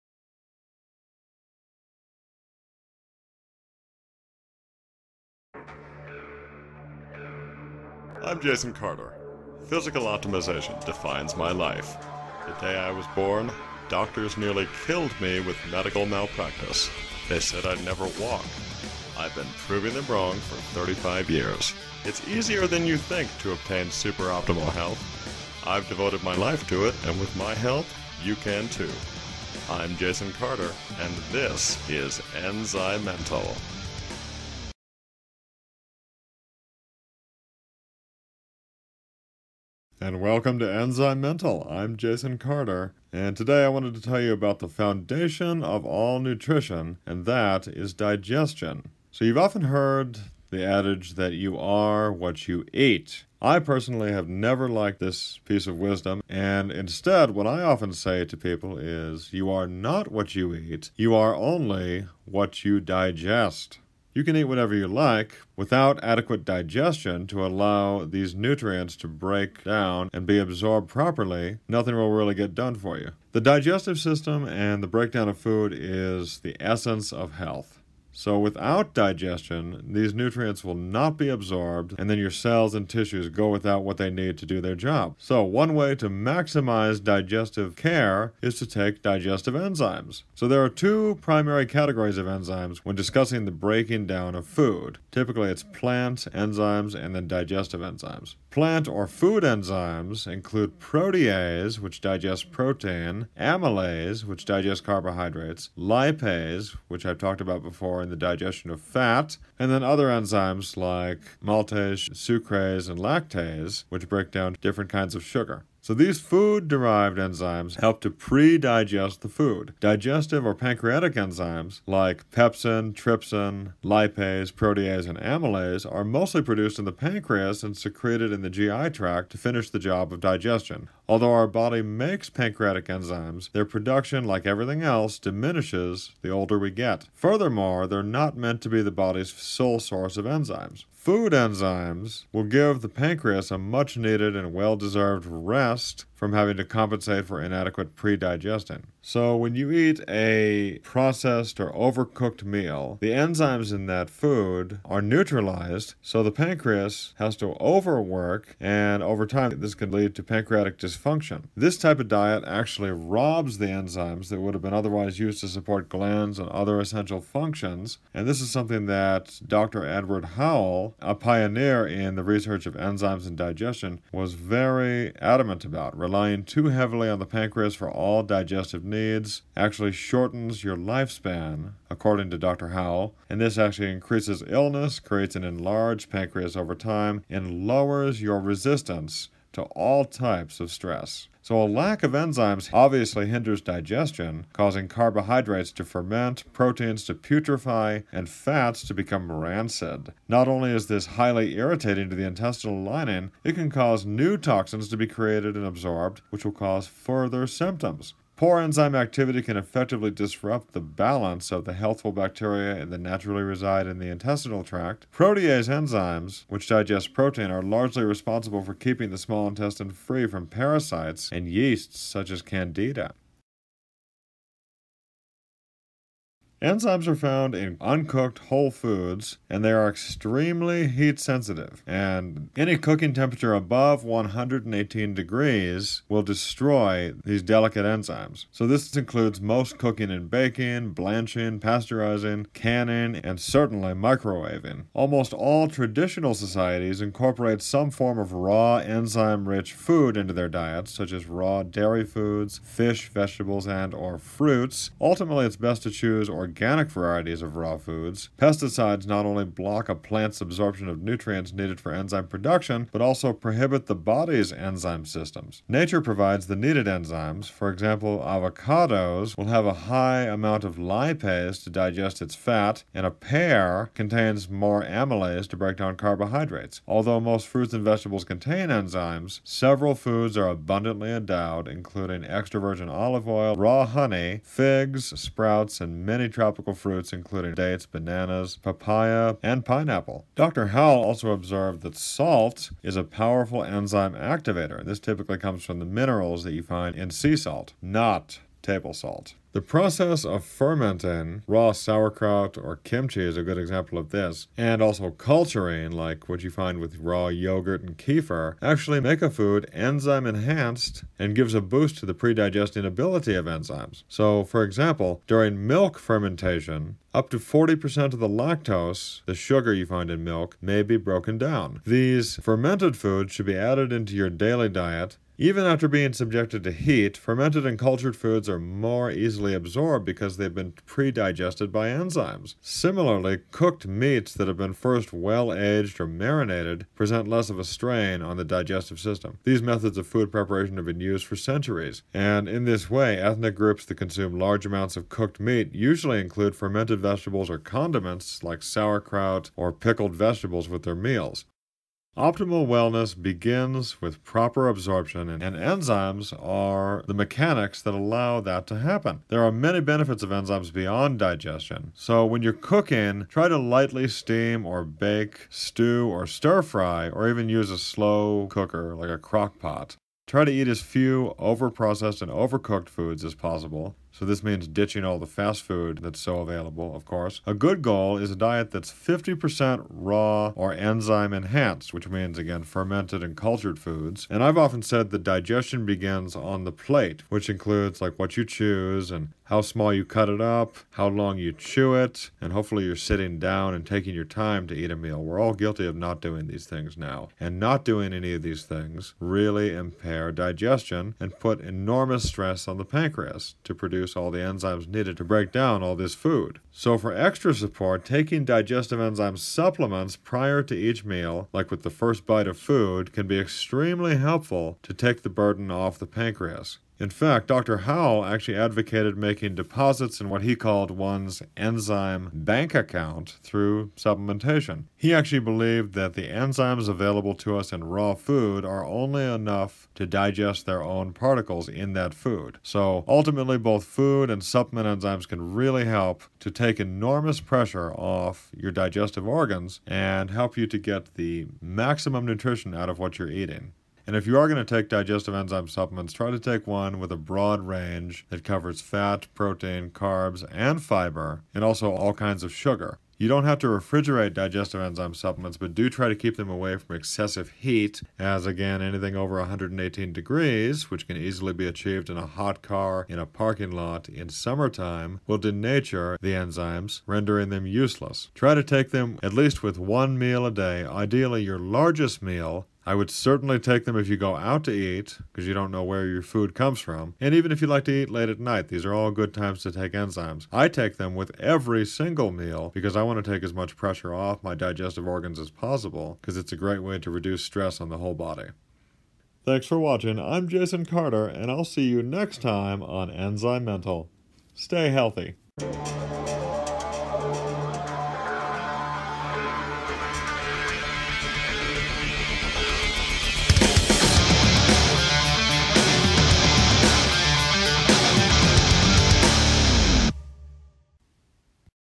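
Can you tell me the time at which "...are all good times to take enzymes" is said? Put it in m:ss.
7:58.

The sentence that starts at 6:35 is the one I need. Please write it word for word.
We're all guilty of not doing these things now.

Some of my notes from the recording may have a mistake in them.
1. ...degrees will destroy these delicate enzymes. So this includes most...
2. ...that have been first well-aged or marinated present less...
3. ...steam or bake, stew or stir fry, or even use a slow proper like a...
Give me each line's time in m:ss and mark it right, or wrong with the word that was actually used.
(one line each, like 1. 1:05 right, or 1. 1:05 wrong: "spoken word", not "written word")
1. 3:55 right
2. 5:34 right
3. 6:04 wrong: "cooker", not "proper".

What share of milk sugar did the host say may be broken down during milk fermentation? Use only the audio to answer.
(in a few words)
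Up to 40%.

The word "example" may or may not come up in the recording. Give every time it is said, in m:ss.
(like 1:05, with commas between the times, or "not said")
4:27, 5:03, 5:14.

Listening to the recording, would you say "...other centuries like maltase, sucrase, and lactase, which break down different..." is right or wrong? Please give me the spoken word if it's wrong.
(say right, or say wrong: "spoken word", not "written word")
wrong: "enzymes", not "centuries".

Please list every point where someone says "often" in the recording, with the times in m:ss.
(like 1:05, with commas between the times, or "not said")
0:49, 0:57, 6:24.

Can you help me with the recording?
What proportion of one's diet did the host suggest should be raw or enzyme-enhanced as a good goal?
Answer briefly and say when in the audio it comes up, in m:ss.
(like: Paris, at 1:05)
50%, at 6:18.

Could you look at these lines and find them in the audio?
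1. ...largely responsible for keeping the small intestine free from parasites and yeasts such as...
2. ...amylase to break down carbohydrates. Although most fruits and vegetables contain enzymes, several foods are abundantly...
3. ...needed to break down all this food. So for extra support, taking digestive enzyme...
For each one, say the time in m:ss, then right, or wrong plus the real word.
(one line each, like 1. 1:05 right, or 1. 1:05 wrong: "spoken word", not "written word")
1. 3:37 right
2. 4:34 right
3. 6:44 right.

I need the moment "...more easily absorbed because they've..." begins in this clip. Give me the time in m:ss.
5:28.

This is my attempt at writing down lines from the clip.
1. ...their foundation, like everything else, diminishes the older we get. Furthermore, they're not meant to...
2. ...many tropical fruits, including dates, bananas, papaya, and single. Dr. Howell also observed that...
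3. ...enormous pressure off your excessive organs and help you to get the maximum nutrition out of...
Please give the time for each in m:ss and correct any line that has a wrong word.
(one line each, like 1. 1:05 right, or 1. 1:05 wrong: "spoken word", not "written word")
1. 2:13 wrong: "production", not "foundation"
2. 4:46 wrong: "pineapple", not "single"
3. 7:16 wrong: "digestive", not "excessive".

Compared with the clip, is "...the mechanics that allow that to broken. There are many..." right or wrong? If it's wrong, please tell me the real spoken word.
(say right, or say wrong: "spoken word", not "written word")
wrong: "happen", not "broken".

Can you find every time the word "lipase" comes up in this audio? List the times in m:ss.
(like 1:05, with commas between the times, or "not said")
1:45, 2:03, 4:30.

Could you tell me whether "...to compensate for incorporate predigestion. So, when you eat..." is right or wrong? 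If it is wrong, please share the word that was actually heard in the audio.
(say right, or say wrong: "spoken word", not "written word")
wrong: "inadequate", not "incorporate".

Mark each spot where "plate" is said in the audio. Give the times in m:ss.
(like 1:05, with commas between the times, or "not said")
6:26.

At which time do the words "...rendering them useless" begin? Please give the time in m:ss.
7:47.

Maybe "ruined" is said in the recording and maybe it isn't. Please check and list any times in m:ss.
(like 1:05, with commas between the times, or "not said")
not said.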